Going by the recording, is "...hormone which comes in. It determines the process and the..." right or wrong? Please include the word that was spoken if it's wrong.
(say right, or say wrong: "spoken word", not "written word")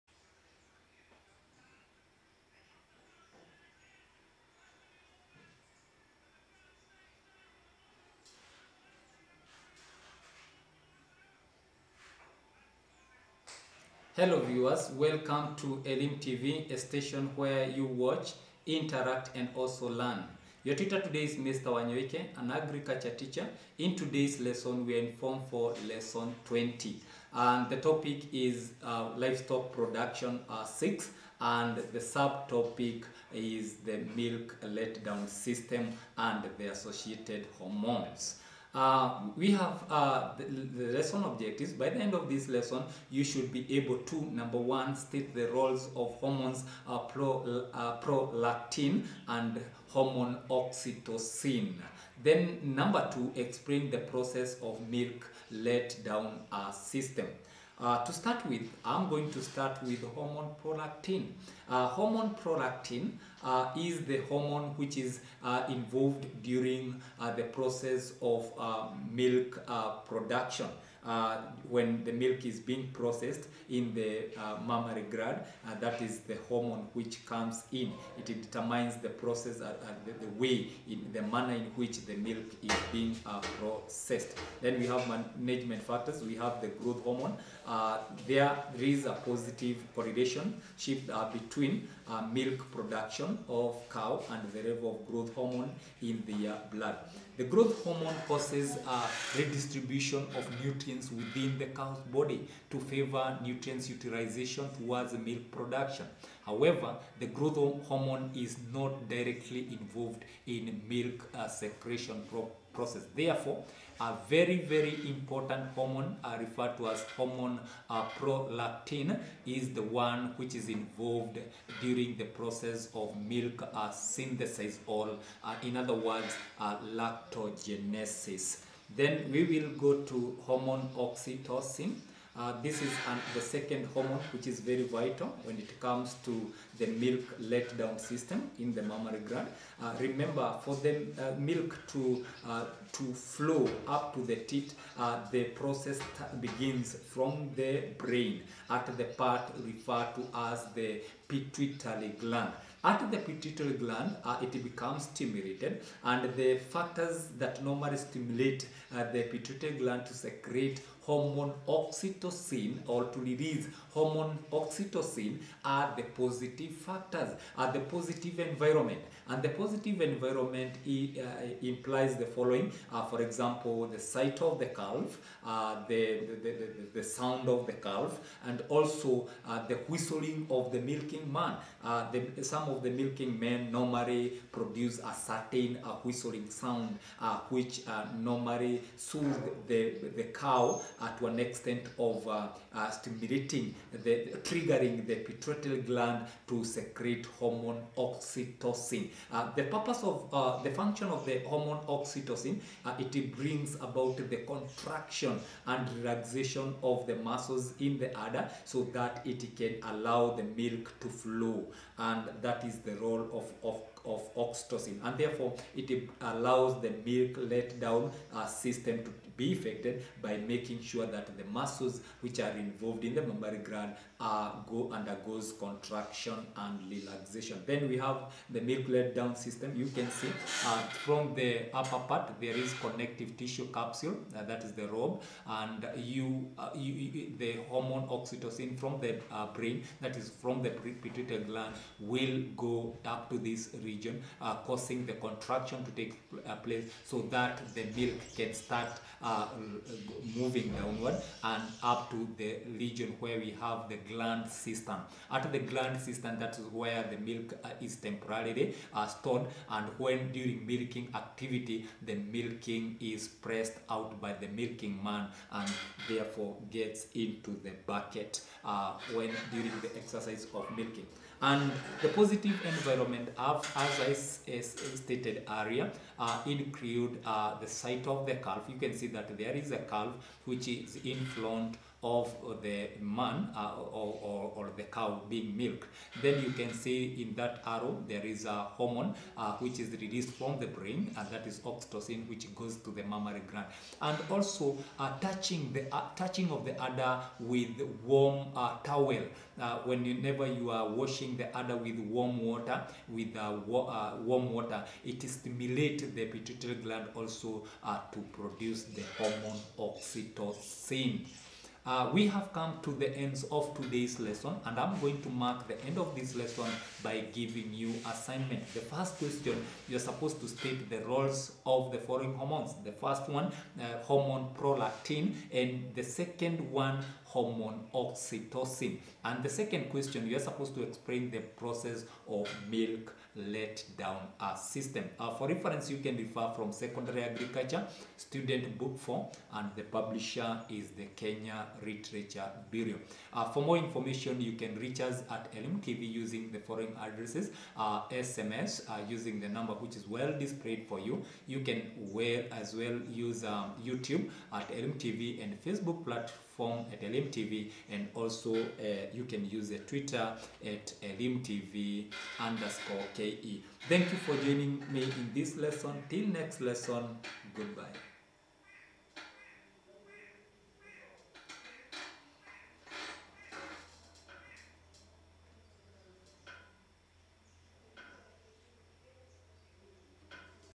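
right.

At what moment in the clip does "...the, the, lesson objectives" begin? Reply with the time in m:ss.
0:40.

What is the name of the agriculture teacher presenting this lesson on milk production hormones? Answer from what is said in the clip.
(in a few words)
Mr. Wanyoike.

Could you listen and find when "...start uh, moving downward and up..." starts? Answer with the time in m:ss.
4:08.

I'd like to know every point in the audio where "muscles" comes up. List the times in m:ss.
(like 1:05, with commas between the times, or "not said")
3:27, 3:41.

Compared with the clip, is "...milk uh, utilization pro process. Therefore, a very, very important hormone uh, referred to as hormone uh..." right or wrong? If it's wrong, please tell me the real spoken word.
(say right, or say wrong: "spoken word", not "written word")
wrong: "secretion", not "utilization".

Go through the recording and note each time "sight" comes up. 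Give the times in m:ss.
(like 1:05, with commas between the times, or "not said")
2:53, 4:37.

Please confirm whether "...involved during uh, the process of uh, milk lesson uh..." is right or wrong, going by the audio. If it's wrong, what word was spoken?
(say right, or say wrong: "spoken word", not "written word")
wrong: "production", not "lesson".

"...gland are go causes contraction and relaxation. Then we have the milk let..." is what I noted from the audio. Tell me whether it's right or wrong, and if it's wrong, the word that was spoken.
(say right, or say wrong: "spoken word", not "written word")
wrong: "undergoes", not "causes".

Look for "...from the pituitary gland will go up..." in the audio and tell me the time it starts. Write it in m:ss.
4:00.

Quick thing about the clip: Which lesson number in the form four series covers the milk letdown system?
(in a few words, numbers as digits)
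20.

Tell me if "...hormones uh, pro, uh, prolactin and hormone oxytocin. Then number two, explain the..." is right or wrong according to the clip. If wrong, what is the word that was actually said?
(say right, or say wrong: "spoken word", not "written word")
right.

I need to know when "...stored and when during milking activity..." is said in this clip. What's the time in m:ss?
4:19.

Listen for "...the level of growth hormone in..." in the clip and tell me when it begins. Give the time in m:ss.
1:34.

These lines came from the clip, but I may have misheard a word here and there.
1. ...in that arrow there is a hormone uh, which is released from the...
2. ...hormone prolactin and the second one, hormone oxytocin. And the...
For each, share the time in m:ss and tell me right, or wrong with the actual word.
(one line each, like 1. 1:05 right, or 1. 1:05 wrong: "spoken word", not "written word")
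1. 4:47 right
2. 5:24 right.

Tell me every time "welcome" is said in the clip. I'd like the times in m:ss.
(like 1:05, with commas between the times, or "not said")
0:14.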